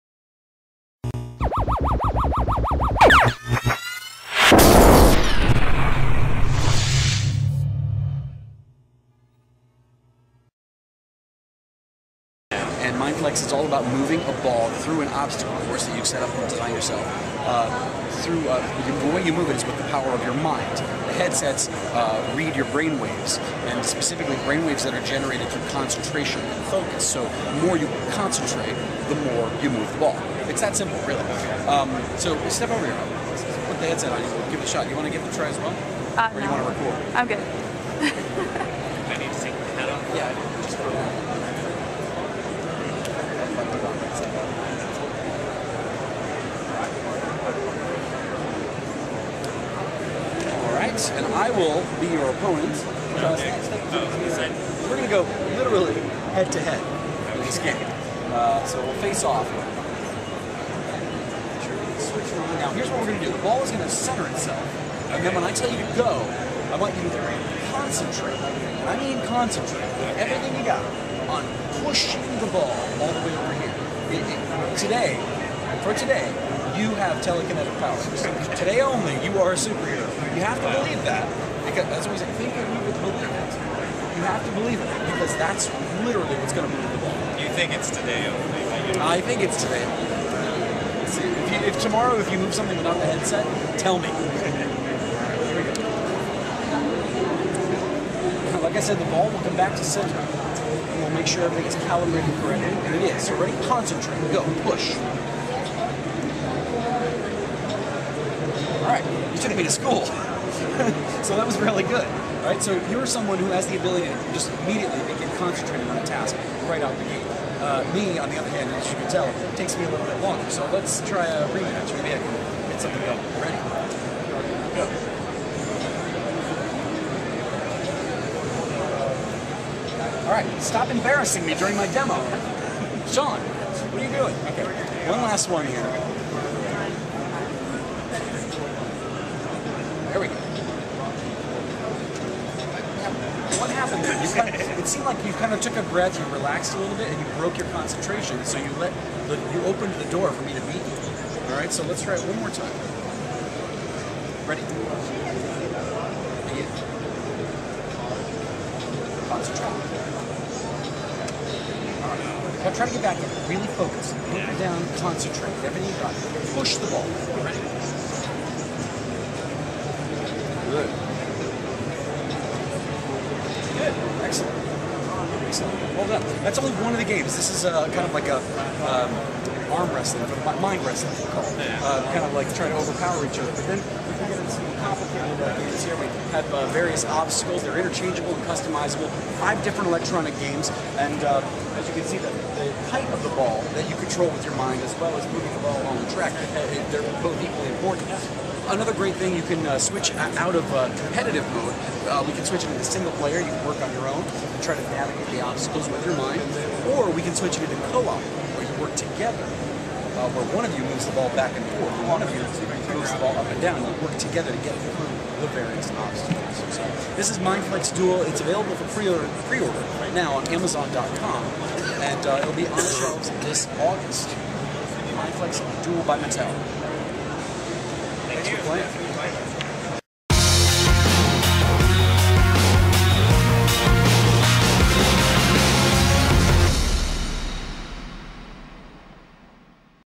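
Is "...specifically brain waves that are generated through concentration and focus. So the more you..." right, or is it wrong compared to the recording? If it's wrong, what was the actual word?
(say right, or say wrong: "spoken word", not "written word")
right.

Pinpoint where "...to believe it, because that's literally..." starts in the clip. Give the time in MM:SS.
01:24.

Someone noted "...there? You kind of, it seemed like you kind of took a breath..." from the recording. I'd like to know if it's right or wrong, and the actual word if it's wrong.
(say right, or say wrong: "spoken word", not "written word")
right.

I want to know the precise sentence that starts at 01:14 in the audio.
It, it, today, for today, you have telekinetic powers.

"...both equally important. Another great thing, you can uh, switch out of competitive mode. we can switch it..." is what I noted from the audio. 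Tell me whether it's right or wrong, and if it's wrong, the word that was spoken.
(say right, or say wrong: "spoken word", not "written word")
right.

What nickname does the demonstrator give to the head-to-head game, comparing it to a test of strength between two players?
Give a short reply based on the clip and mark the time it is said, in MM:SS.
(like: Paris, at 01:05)
mind wrestling, at 03:00.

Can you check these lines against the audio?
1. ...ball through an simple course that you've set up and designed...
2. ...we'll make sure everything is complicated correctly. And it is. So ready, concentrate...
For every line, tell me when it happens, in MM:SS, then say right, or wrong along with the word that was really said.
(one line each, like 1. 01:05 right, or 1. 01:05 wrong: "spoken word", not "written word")
1. 00:14 wrong: "obstacle", not "simple"
2. 01:41 wrong: "calibrated", not "complicated".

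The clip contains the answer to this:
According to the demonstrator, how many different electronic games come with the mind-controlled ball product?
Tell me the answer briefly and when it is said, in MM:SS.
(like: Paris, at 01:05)
5, at 03:09.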